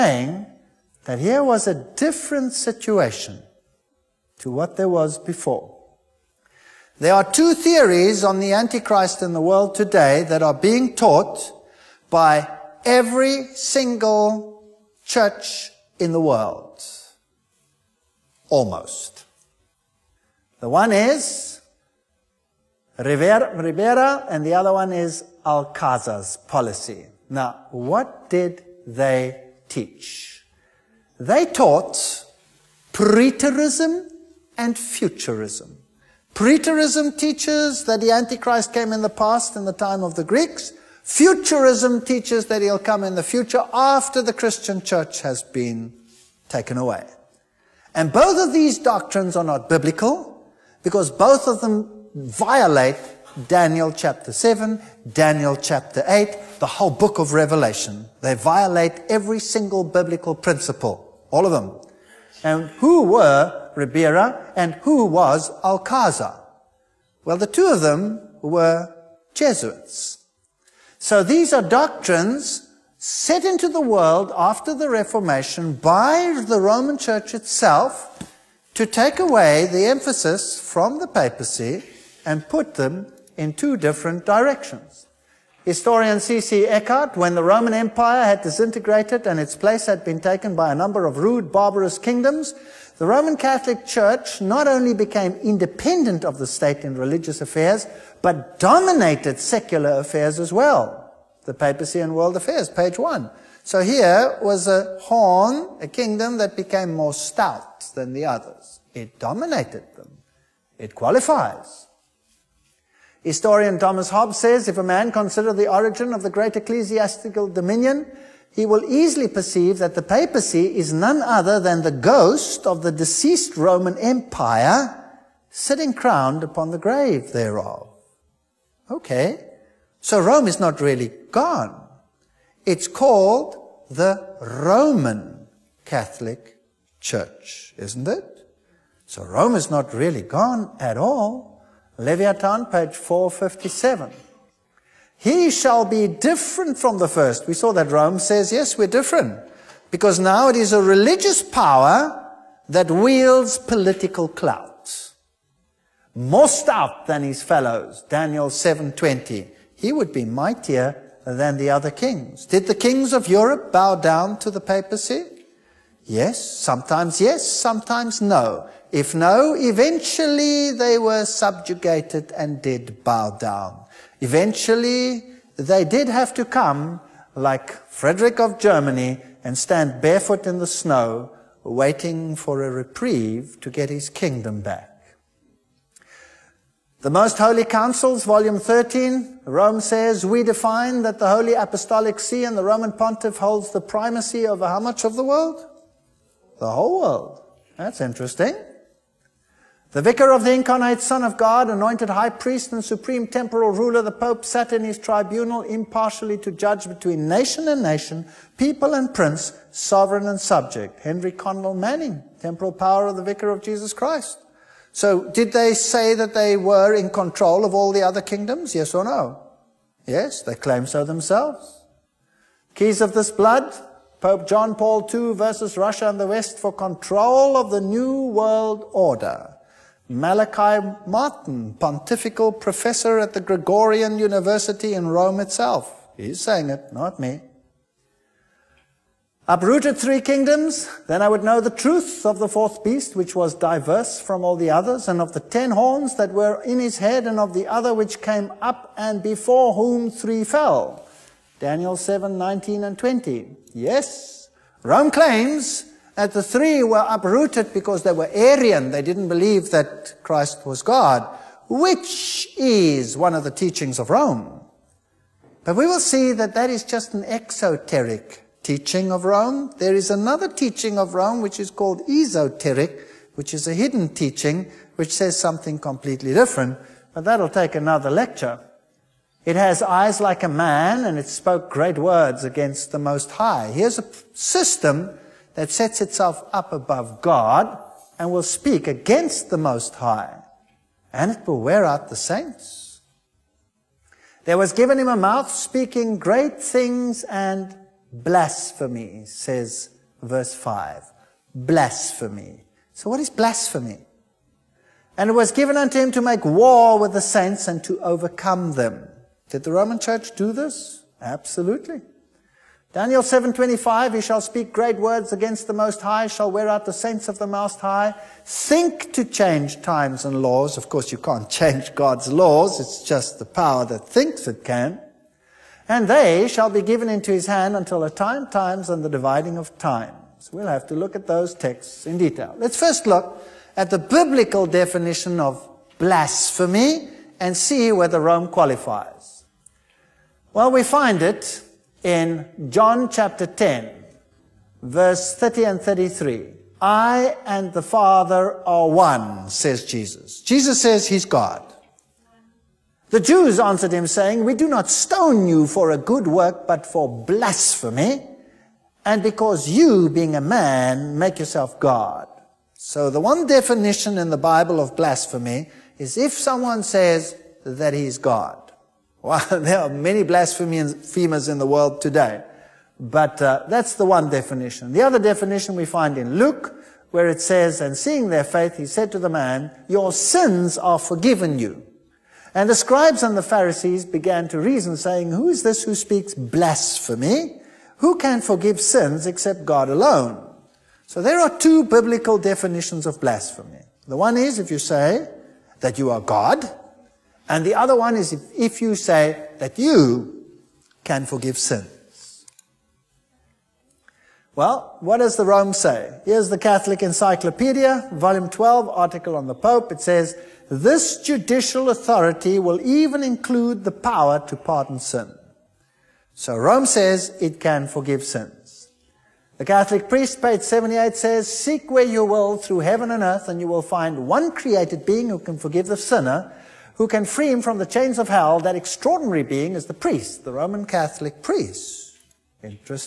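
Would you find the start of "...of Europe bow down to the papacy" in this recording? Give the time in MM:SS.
02:43.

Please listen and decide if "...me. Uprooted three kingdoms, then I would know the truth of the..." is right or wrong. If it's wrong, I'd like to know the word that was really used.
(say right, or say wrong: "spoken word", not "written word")
right.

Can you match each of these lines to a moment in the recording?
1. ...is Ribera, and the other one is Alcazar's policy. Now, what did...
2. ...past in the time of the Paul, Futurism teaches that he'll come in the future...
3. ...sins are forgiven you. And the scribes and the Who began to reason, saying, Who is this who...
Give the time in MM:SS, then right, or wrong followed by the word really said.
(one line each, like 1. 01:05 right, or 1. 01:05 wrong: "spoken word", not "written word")
1. 00:20 right
2. 00:39 wrong: "Greeks", not "Paul"
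3. 06:20 wrong: "Pharisees", not "Who".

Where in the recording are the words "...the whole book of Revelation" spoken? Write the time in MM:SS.
00:56.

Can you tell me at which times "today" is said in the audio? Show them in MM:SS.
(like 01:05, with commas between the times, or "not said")
00:09, 06:12.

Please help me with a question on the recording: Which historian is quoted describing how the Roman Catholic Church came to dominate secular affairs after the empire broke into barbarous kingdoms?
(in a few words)
C.C. Eckhardt.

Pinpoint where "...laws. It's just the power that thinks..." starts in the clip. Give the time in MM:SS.
05:22.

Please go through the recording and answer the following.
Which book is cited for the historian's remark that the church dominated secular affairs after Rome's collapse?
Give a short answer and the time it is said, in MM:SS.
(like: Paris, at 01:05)
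The Papacy and World Affairs, at 01:41.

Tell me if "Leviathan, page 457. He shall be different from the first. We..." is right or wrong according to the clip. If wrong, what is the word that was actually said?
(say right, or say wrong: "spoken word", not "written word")
right.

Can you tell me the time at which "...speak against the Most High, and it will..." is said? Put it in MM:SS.
04:48.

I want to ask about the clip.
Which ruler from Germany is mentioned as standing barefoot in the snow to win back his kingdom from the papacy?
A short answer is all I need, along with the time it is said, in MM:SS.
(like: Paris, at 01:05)
Frederick, at 02:57.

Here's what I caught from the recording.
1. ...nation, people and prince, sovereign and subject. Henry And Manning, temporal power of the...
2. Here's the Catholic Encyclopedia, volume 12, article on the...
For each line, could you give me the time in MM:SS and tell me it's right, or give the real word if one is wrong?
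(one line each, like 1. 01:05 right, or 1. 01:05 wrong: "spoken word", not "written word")
1. 03:27 wrong: "Cardinal", not "And"
2. 06:46 right.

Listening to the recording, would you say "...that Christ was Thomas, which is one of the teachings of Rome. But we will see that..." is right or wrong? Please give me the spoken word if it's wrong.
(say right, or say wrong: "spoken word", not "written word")
wrong: "God", not "Thomas".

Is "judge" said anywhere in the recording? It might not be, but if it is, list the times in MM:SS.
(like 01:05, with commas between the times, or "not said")
03:26.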